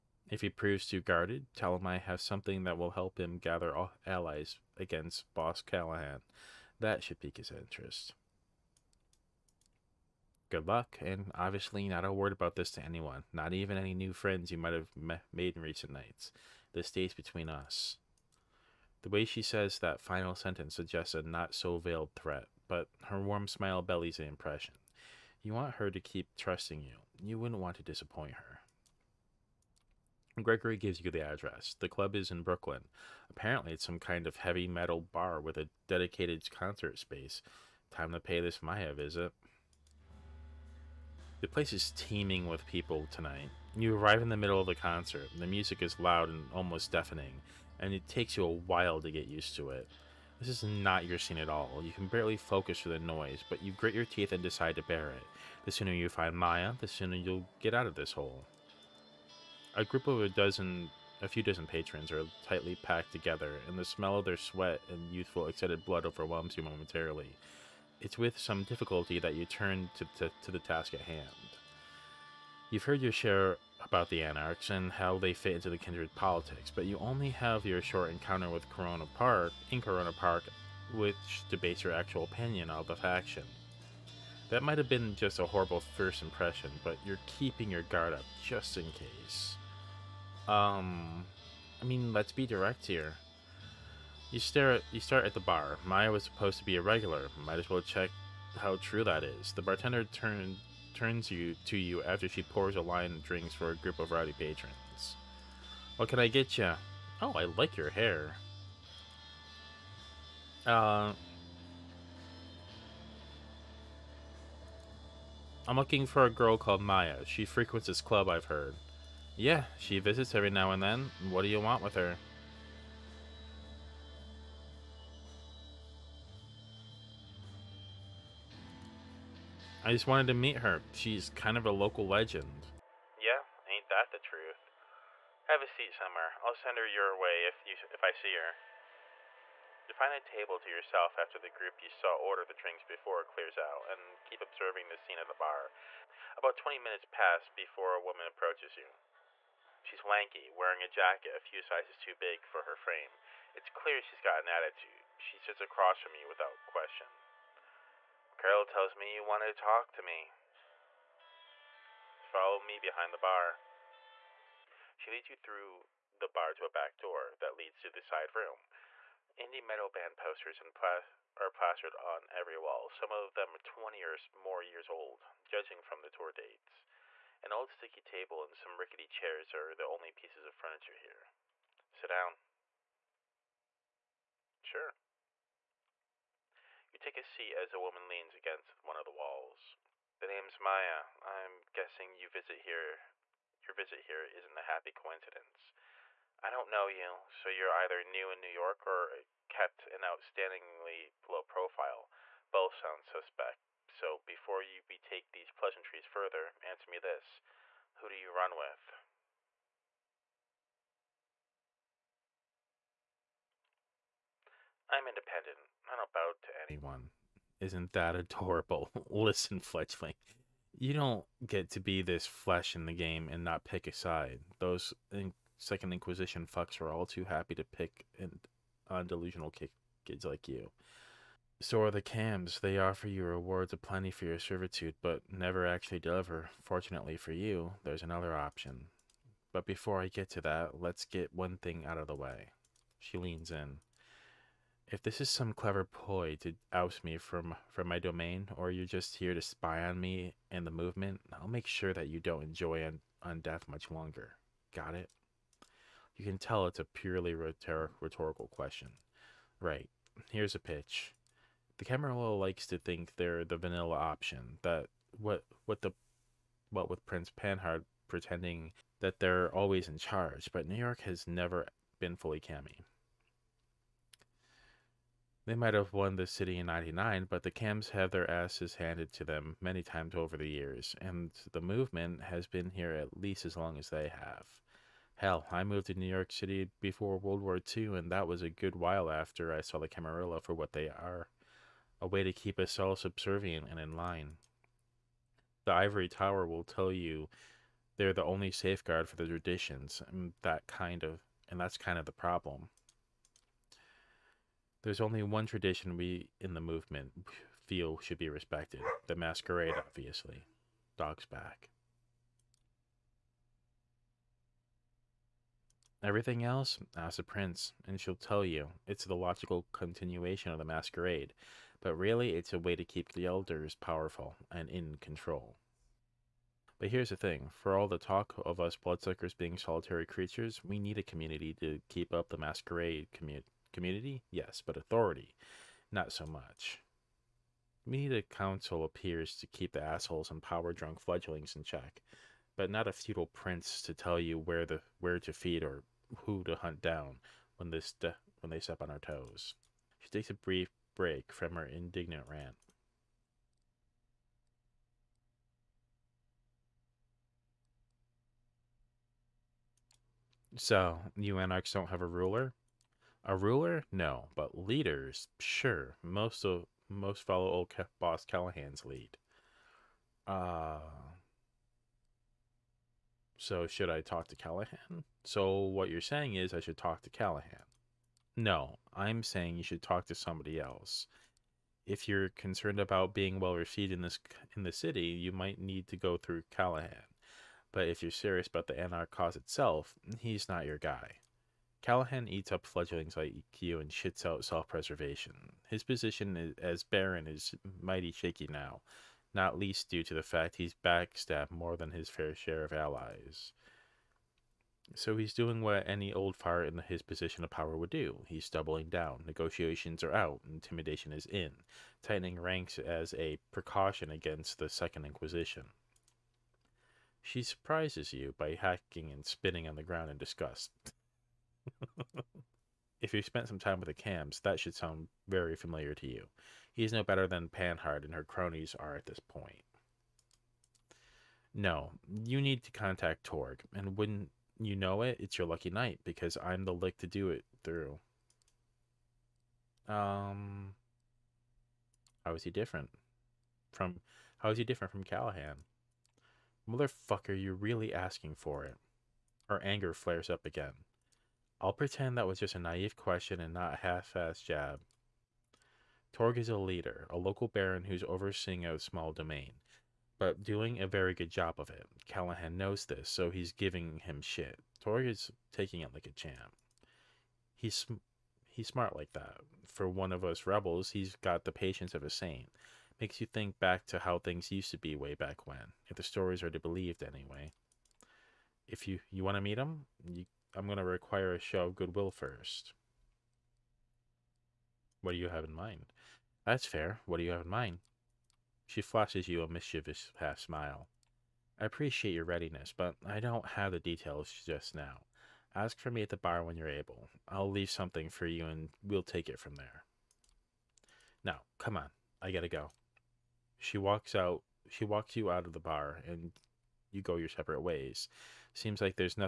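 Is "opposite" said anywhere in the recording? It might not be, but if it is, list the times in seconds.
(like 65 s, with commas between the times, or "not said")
not said.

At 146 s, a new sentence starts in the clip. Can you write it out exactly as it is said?
About 20 minutes pass before a woman approaches you.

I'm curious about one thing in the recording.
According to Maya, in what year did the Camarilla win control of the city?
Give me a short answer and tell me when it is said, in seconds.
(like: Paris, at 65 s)
1999, at 276 s.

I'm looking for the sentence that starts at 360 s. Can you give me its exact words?
So, you anarchs don't have a ruler?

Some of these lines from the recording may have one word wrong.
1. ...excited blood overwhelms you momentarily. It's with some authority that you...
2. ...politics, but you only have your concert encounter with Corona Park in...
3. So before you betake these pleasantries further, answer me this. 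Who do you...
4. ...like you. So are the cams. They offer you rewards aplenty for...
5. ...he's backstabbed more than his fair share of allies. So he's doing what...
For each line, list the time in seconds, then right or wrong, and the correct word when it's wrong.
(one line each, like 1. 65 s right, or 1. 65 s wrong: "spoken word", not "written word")
1. 65 s wrong: "difficulty", not "authority"
2. 76 s wrong: "short", not "concert"
3. 203 s right
4. 230 s right
5. 400 s right.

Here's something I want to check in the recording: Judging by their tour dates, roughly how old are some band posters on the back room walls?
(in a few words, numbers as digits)
20.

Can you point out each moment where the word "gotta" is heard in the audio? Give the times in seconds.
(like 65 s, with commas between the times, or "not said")
502 s.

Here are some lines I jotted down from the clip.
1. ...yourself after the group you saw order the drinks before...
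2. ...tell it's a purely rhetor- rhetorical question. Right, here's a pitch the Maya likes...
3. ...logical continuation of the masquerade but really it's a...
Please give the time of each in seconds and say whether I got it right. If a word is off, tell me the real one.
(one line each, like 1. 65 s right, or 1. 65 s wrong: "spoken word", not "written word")
1. 140 s right
2. 256 s wrong: "Camarilla", not "Maya"
3. 319 s right.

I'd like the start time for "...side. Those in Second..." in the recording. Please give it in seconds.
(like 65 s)
223 s.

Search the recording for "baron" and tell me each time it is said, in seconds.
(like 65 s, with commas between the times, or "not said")
396 s, 457 s.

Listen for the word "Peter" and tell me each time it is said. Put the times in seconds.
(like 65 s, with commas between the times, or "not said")
not said.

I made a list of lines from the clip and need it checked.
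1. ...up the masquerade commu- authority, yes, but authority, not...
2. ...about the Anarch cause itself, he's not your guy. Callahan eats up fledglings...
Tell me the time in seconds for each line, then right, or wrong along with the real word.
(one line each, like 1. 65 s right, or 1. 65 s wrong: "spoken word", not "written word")
1. 332 s wrong: "community", not "authority"
2. 388 s right.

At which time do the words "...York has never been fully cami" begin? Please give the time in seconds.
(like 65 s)
270 s.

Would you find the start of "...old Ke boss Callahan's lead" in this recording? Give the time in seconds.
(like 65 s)
367 s.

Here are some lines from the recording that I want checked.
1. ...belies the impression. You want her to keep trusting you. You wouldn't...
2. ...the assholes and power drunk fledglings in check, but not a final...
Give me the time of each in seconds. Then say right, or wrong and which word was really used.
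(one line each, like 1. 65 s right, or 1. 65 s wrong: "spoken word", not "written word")
1. 23 s right
2. 339 s wrong: "feudal", not "final".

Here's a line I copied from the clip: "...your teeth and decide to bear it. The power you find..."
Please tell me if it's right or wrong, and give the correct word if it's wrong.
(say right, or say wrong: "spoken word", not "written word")
wrong: "sooner", not "power".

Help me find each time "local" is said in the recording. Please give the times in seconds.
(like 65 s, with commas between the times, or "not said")
131 s, 457 s.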